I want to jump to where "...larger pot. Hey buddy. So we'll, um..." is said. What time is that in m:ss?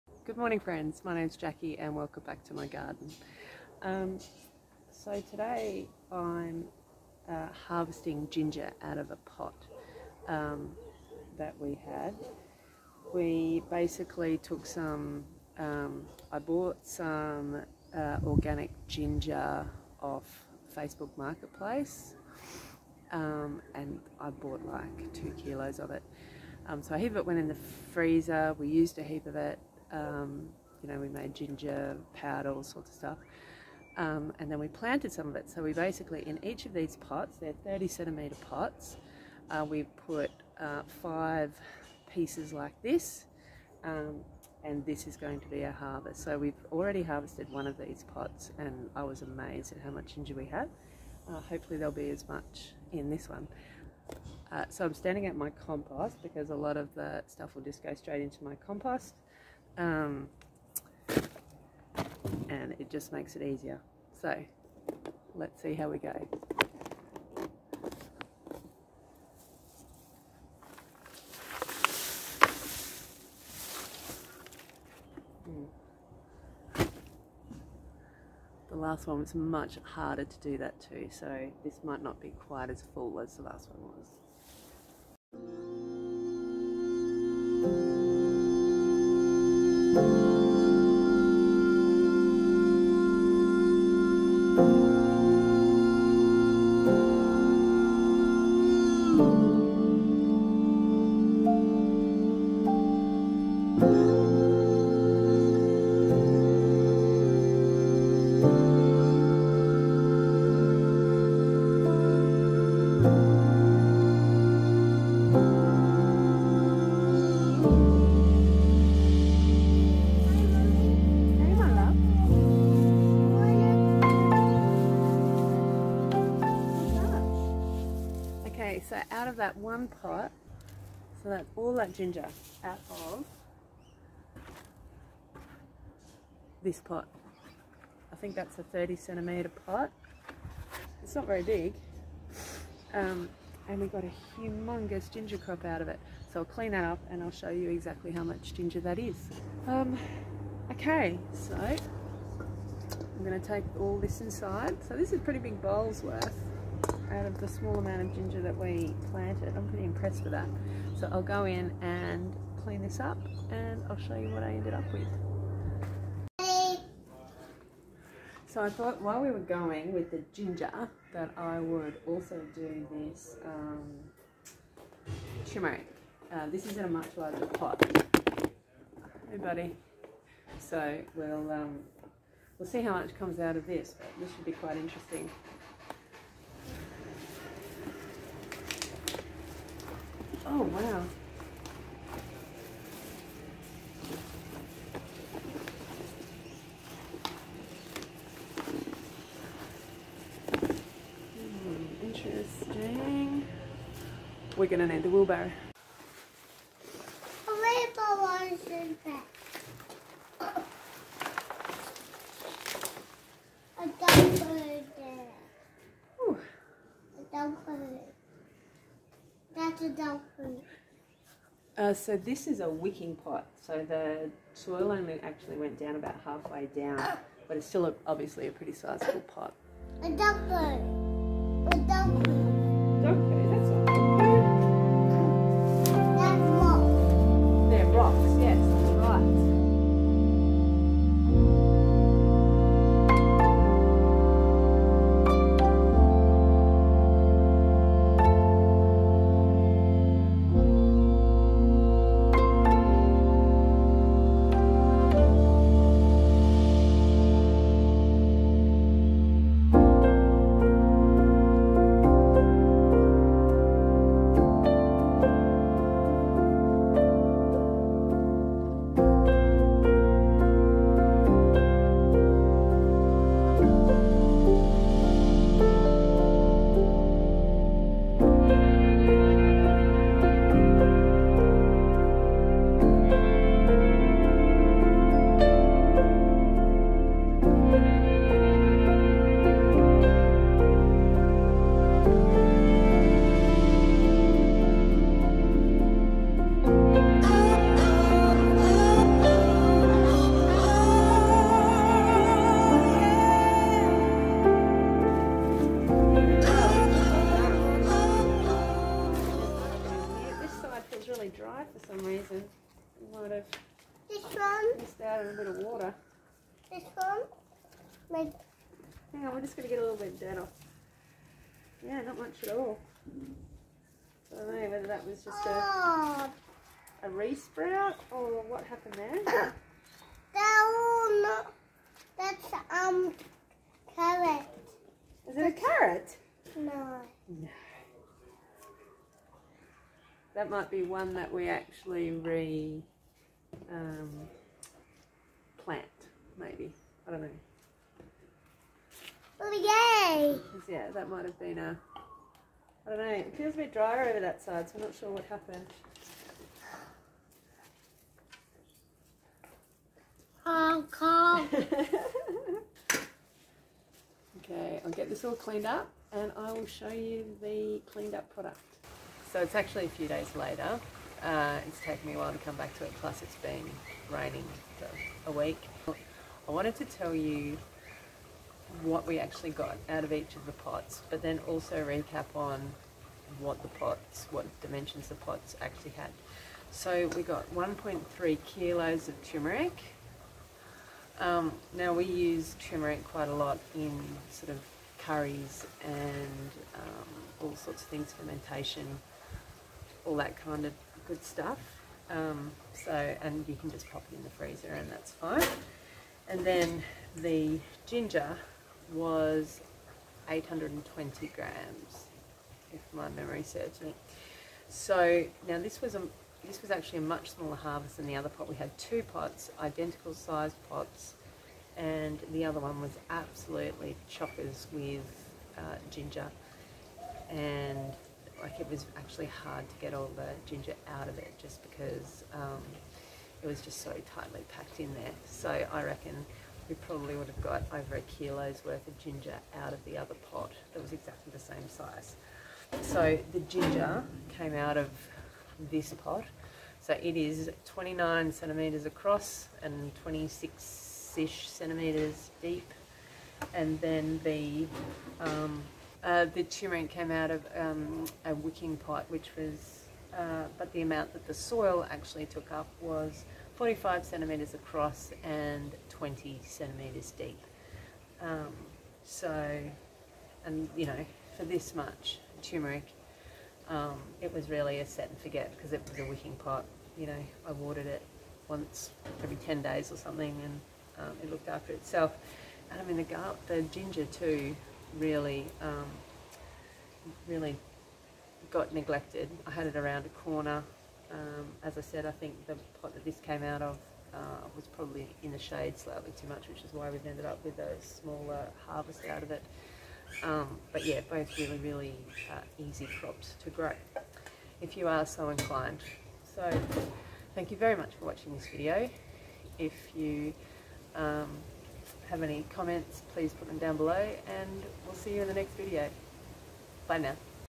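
2:57.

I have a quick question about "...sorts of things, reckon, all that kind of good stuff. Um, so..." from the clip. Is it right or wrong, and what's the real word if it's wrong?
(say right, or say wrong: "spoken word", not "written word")
wrong: "fermentation", not "reckon".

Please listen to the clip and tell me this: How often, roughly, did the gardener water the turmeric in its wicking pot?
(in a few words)
once every 10 days.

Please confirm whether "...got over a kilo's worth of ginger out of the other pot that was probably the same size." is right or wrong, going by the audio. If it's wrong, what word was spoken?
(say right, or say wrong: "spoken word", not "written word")
wrong: "exactly", not "probably".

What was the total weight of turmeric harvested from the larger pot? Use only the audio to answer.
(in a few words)
1.3 kilos.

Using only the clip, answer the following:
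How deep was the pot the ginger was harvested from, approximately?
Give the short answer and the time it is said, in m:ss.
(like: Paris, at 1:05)
26 centimetres, at 7:30.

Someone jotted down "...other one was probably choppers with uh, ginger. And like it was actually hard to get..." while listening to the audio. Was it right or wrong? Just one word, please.
wrong.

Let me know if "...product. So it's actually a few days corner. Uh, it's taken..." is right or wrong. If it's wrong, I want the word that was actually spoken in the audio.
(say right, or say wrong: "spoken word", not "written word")
wrong: "later", not "corner".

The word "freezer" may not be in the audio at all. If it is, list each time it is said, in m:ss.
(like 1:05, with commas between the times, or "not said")
0:27, 6:44.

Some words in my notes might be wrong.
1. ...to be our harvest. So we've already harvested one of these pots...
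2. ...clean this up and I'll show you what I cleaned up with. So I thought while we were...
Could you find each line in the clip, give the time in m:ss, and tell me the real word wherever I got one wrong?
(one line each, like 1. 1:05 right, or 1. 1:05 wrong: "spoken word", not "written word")
1. 0:45 right
2. 2:42 wrong: "ended", not "cleaned".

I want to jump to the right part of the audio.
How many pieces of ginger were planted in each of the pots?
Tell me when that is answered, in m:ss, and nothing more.
0:41.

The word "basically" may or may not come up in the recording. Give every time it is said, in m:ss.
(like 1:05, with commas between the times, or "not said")
0:13, 0:35.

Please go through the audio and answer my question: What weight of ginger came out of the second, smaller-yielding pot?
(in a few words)
820 grams.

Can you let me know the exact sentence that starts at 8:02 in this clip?
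And I mean, the, gar- the ginger too, really, um, really got neglected.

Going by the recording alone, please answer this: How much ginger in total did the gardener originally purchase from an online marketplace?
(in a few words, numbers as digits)
2 kilos.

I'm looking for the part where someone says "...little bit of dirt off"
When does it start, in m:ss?
5:19.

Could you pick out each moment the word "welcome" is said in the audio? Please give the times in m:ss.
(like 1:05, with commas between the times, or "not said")
0:01.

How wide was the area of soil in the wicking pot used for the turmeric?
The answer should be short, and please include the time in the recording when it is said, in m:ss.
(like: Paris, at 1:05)
45 centimetres, at 7:43.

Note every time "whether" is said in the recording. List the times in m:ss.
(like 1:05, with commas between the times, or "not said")
5:24.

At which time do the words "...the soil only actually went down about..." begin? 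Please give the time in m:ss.
3:43.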